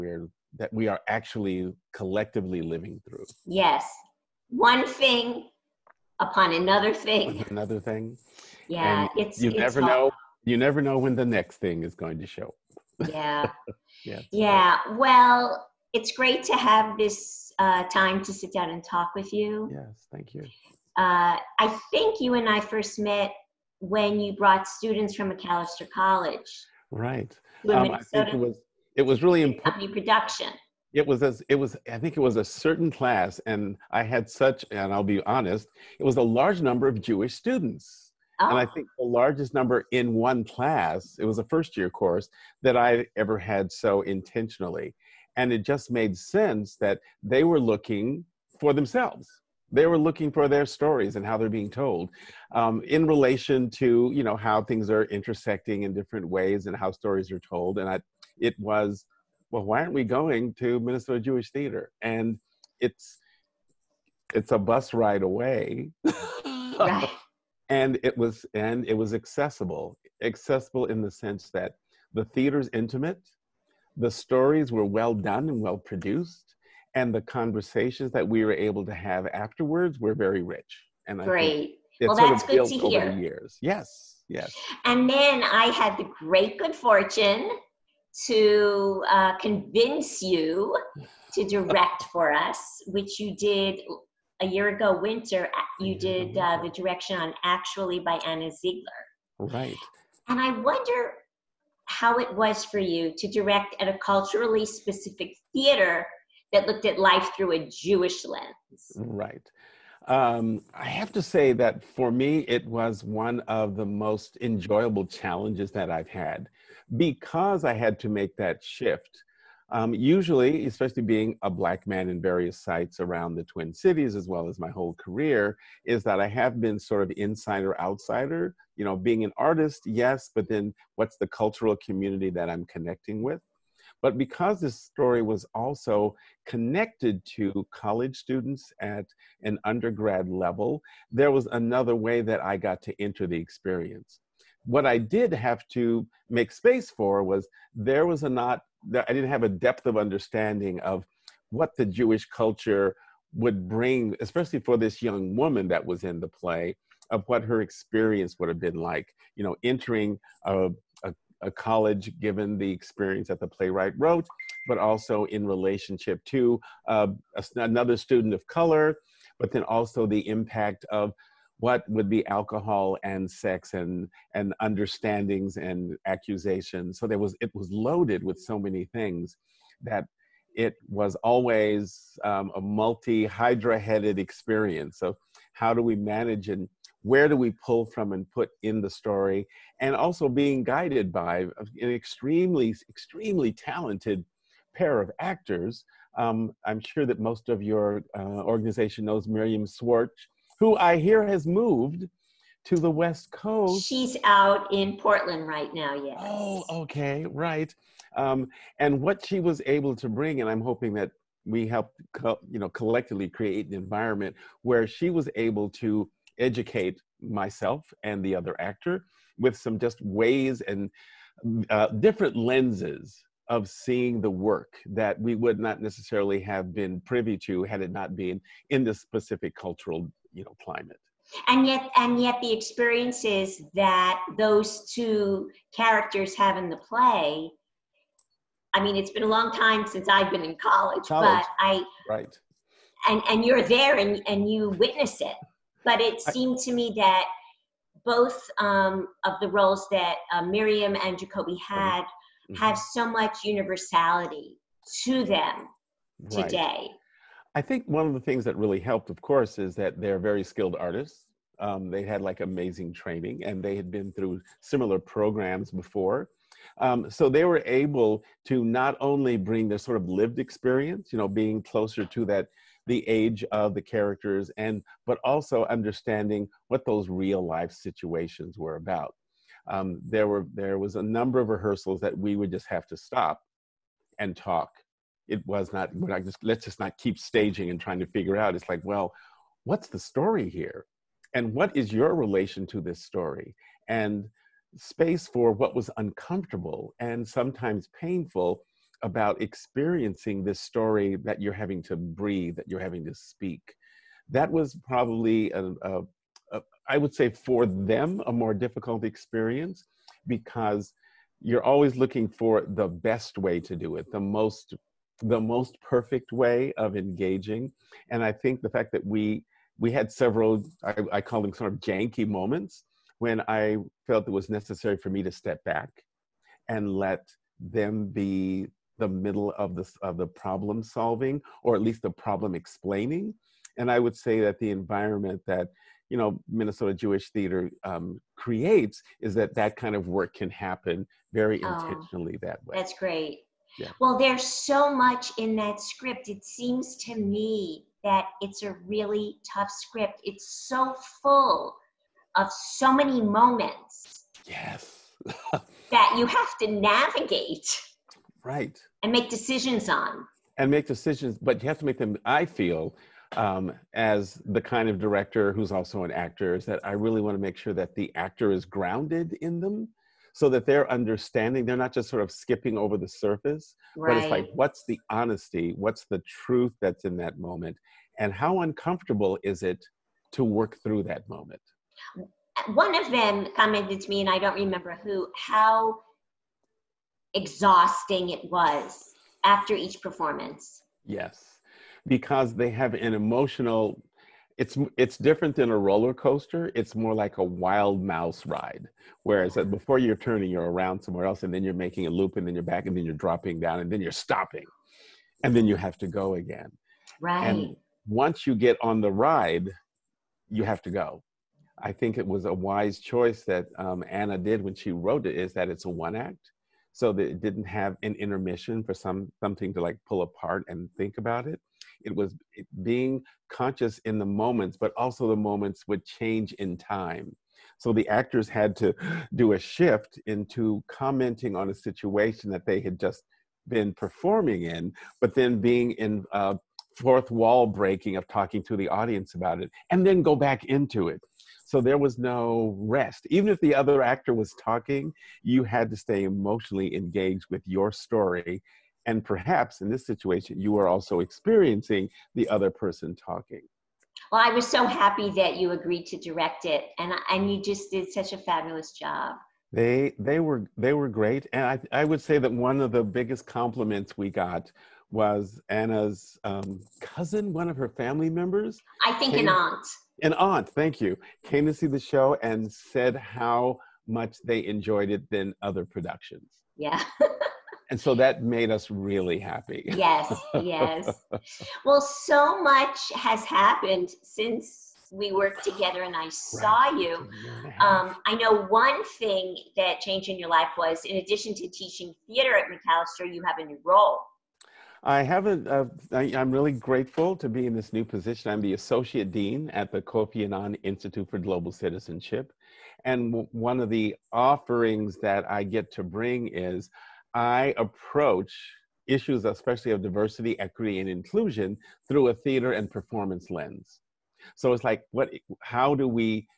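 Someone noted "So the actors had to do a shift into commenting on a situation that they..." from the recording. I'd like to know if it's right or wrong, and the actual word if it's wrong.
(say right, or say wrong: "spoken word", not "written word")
right.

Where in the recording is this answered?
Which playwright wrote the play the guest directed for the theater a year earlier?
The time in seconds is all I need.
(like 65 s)
98 s.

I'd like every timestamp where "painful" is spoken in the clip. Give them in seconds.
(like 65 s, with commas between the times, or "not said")
297 s.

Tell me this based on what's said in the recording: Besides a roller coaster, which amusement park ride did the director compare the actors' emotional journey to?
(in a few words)
wild mouse ride.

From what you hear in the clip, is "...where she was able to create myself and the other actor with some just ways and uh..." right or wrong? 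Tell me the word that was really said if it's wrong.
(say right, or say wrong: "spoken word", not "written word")
wrong: "educate", not "create".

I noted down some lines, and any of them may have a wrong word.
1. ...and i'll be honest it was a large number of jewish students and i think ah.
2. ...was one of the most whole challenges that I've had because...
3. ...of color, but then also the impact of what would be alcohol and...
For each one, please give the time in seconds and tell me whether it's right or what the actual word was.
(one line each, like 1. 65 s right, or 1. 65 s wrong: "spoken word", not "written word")
1. 34 s right
2. 112 s wrong: "enjoyable", not "whole"
3. 168 s right.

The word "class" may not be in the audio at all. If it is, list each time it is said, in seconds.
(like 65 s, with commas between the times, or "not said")
32 s, 40 s.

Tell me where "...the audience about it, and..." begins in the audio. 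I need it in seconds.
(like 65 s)
438 s.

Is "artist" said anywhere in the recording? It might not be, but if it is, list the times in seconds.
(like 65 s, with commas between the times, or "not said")
129 s, 260 s.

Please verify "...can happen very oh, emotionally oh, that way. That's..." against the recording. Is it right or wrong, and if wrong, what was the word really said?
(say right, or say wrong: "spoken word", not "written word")
wrong: "intentionally", not "emotionally".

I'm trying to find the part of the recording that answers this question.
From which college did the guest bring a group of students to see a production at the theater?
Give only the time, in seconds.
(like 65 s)
25 s.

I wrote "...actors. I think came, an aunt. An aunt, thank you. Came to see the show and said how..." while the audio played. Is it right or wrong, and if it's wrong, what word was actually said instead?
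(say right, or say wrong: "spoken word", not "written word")
wrong: "members", not "actors".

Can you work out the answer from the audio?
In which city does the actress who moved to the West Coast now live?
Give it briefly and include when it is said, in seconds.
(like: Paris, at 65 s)
Portland, at 204 s.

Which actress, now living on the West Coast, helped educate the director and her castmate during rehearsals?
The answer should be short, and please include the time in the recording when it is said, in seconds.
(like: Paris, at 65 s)
Miriam Schwartz, at 199 s.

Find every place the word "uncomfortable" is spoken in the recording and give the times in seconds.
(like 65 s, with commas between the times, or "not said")
295 s, 378 s.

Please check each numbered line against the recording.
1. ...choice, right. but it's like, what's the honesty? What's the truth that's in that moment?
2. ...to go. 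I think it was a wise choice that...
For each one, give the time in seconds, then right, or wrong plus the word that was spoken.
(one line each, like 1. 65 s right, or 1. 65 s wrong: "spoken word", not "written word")
1. 373 s wrong: "surface", not "choice"
2. 410 s right.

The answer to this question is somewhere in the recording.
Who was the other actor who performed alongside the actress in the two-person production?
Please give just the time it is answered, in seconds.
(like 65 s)
251 s.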